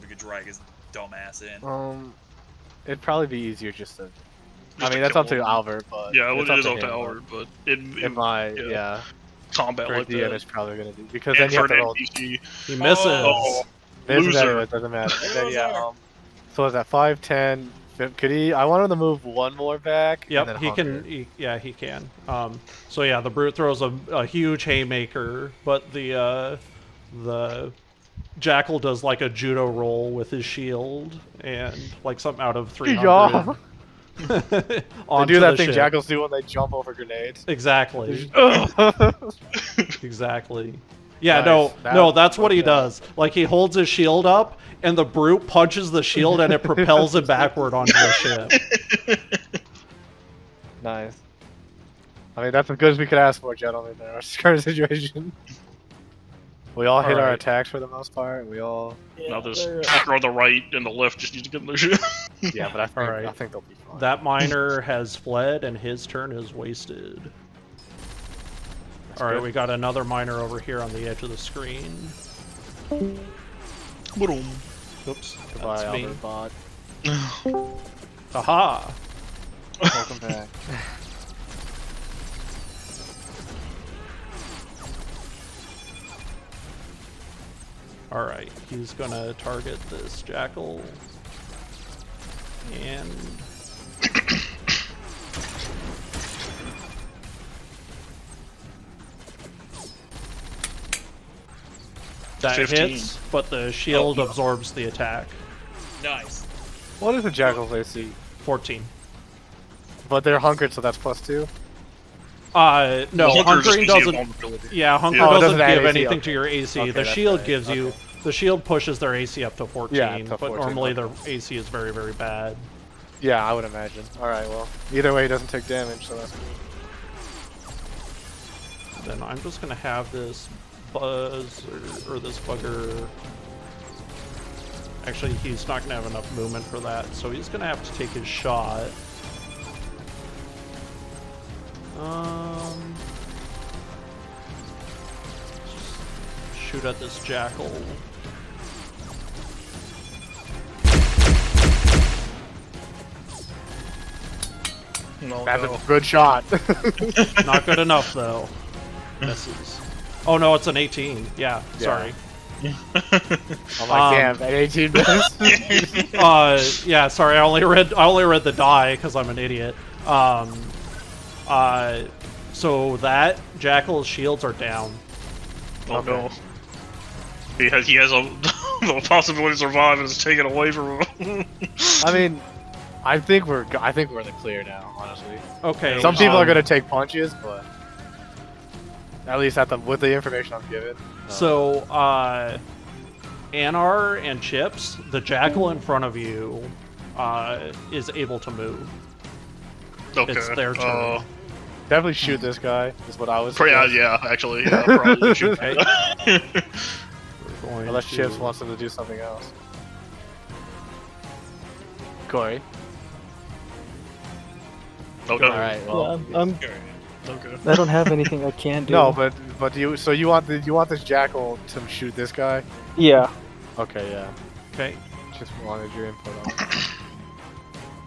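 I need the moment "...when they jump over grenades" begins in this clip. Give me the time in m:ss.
0:36.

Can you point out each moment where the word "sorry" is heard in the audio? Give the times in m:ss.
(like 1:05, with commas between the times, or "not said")
2:41, 2:47.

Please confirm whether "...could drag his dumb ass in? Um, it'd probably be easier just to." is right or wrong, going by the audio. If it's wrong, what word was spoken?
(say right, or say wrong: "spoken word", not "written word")
right.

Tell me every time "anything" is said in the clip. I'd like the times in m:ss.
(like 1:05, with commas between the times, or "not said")
1:55, 3:38.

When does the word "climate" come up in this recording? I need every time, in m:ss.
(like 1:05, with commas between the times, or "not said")
not said.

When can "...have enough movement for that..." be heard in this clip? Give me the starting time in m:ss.
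2:15.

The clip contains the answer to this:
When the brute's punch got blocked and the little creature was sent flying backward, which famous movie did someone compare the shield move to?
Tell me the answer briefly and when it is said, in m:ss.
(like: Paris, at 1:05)
300, at 0:32.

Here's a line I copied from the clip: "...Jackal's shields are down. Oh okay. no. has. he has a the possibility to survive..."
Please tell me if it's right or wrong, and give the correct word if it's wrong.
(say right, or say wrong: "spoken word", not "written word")
right.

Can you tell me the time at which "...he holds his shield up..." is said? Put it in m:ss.
0:43.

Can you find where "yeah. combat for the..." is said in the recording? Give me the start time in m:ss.
0:08.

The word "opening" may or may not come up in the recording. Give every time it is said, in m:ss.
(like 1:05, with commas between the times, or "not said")
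not said.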